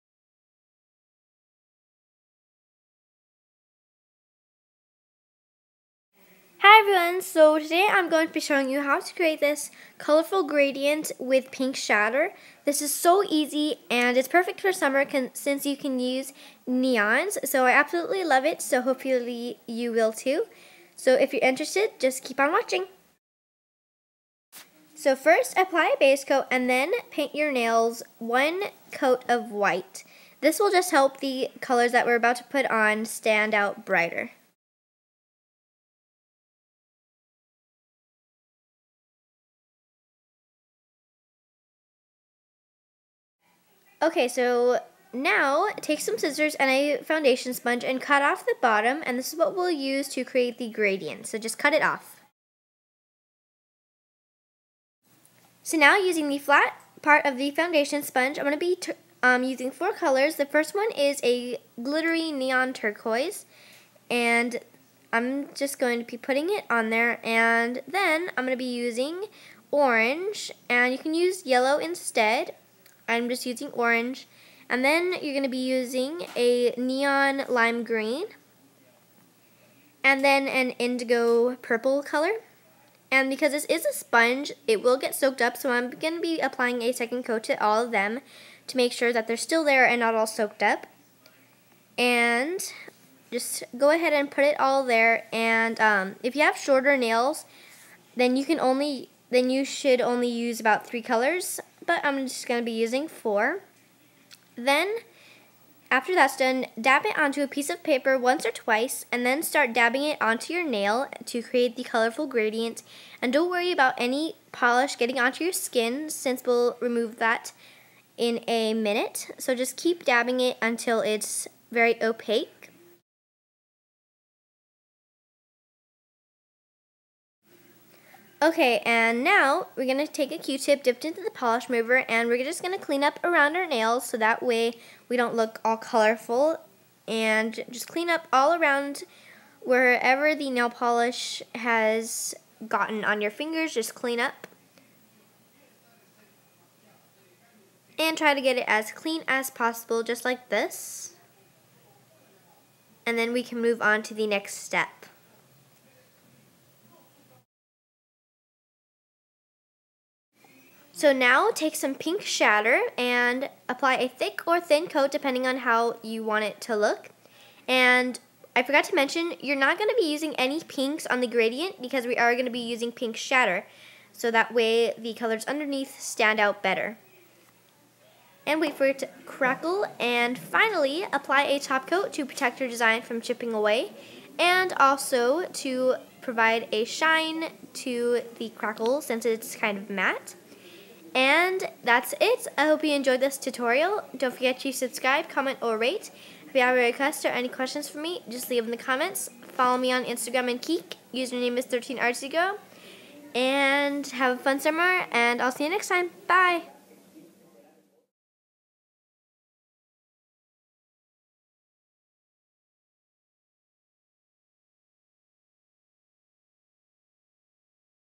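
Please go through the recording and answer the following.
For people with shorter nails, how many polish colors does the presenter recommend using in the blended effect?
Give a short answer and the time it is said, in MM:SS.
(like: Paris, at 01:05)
3, at 01:40.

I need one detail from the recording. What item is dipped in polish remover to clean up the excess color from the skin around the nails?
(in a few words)
Q-tip.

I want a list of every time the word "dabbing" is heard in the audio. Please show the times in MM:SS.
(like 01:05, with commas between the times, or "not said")
01:49, 02:00.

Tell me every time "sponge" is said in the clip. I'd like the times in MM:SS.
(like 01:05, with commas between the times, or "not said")
00:47, 00:58, 01:23.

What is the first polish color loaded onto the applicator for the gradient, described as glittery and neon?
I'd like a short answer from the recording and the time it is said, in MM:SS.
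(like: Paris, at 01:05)
Neon turquoise, at 01:02.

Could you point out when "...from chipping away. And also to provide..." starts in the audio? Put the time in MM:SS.
03:03.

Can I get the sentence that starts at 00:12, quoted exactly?
This is so easy and it's perfect for summer since you can use neons.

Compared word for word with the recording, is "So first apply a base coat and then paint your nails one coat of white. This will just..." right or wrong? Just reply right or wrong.
right.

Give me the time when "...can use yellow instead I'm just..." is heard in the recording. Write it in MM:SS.
01:10.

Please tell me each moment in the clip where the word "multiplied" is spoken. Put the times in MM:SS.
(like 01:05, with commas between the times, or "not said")
not said.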